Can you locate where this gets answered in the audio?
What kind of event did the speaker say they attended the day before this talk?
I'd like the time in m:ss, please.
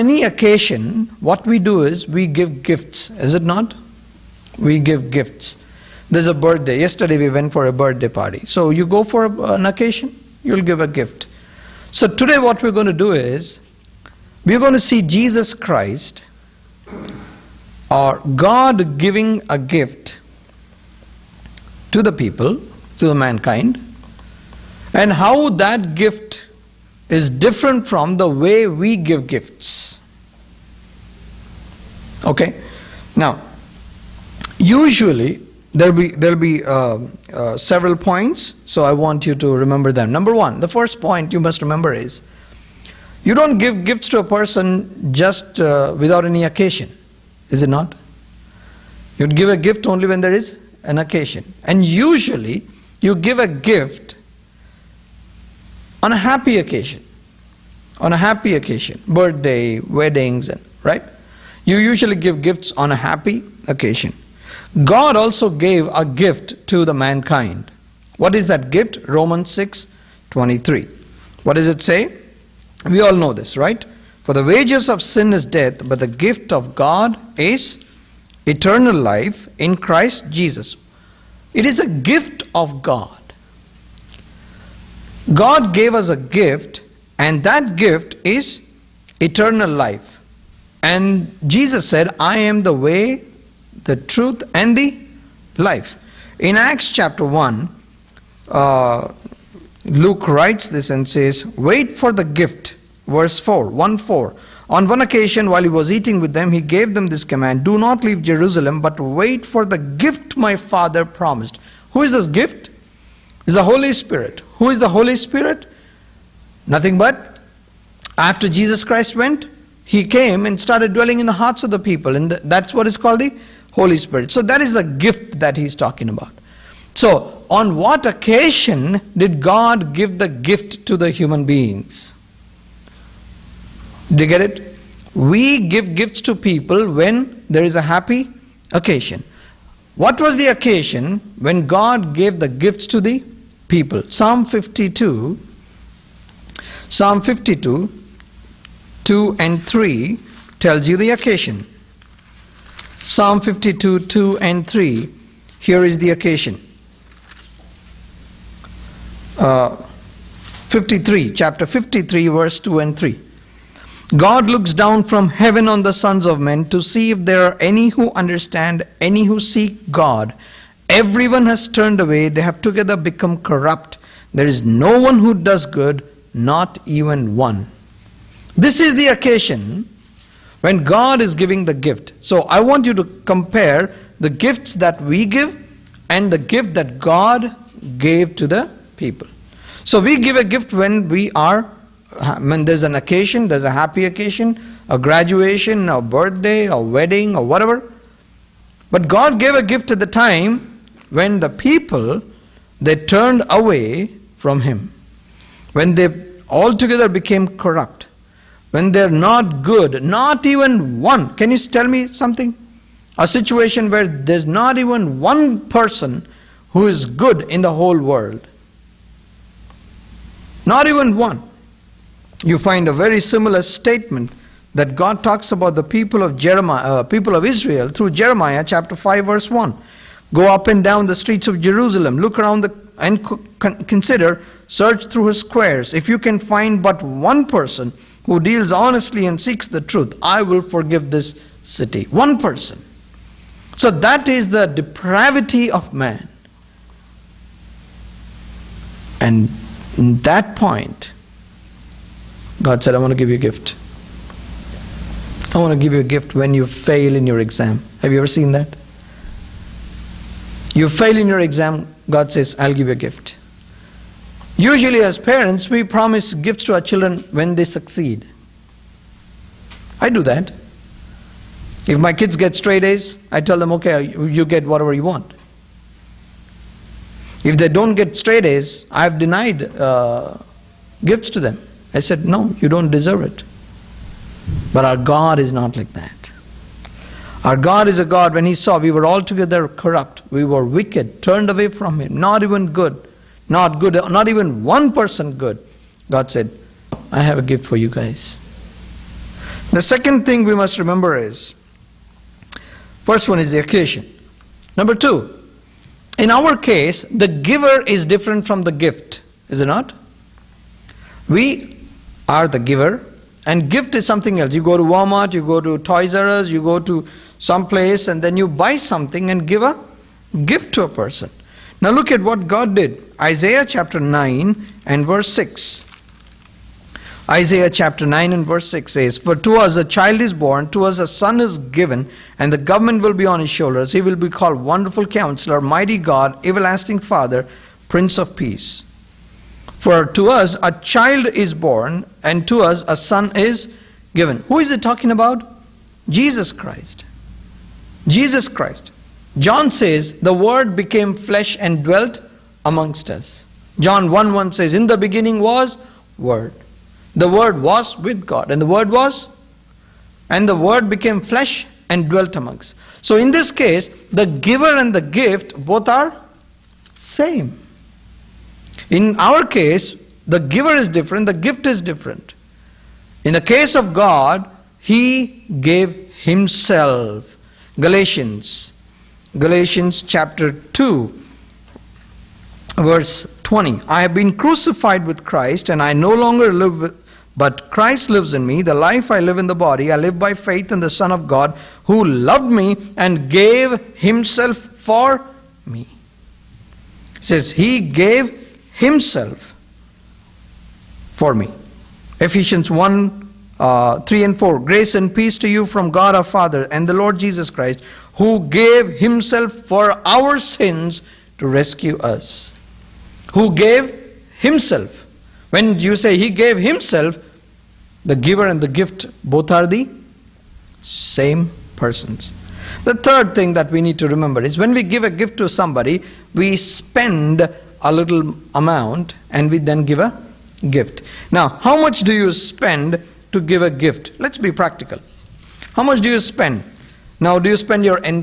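0:07.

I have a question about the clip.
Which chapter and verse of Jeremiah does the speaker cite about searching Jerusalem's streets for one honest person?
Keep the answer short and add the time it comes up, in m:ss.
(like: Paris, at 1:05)
Chapter 5 verse 1, at 3:48.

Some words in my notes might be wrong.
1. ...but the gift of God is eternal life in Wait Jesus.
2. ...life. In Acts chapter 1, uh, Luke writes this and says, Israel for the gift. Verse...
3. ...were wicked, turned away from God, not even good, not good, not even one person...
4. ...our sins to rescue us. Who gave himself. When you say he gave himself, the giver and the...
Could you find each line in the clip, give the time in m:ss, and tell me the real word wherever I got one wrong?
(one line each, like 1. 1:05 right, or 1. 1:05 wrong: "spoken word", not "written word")
1. 1:15 wrong: "Christ", not "Wait"
2. 1:35 wrong: "Wait", not "Israel"
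3. 4:50 wrong: "Him", not "God"
4. 6:50 right.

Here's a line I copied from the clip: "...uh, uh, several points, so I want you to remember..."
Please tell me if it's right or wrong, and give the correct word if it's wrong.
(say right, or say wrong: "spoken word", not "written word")
right.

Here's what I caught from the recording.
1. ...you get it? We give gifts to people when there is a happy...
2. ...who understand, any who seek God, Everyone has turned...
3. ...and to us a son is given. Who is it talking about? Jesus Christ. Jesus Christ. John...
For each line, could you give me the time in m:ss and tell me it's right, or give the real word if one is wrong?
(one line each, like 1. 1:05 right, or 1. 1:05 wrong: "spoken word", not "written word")
1. 2:14 right
2. 2:47 right
3. 5:42 right.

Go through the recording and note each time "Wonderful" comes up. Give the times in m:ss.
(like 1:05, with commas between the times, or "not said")
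5:34.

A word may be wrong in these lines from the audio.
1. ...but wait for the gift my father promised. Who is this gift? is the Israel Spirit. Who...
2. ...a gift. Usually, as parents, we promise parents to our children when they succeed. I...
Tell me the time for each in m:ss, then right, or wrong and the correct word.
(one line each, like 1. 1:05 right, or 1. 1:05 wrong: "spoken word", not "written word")
1. 1:48 wrong: "Holy", not "Israel"
2. 4:22 wrong: "gifts", not "parents".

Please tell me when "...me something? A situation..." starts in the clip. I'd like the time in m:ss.
3:31.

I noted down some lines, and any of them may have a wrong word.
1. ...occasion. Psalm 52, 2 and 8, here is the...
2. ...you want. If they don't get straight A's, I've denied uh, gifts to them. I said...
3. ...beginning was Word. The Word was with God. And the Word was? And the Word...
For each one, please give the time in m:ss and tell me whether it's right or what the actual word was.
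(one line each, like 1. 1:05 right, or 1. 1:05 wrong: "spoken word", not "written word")
1. 2:31 wrong: "3", not "8"
2. 4:34 right
3. 5:54 right.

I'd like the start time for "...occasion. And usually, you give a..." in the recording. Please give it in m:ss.
0:50.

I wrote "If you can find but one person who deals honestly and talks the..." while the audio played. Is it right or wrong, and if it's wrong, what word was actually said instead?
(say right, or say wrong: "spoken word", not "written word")
wrong: "seeks", not "talks".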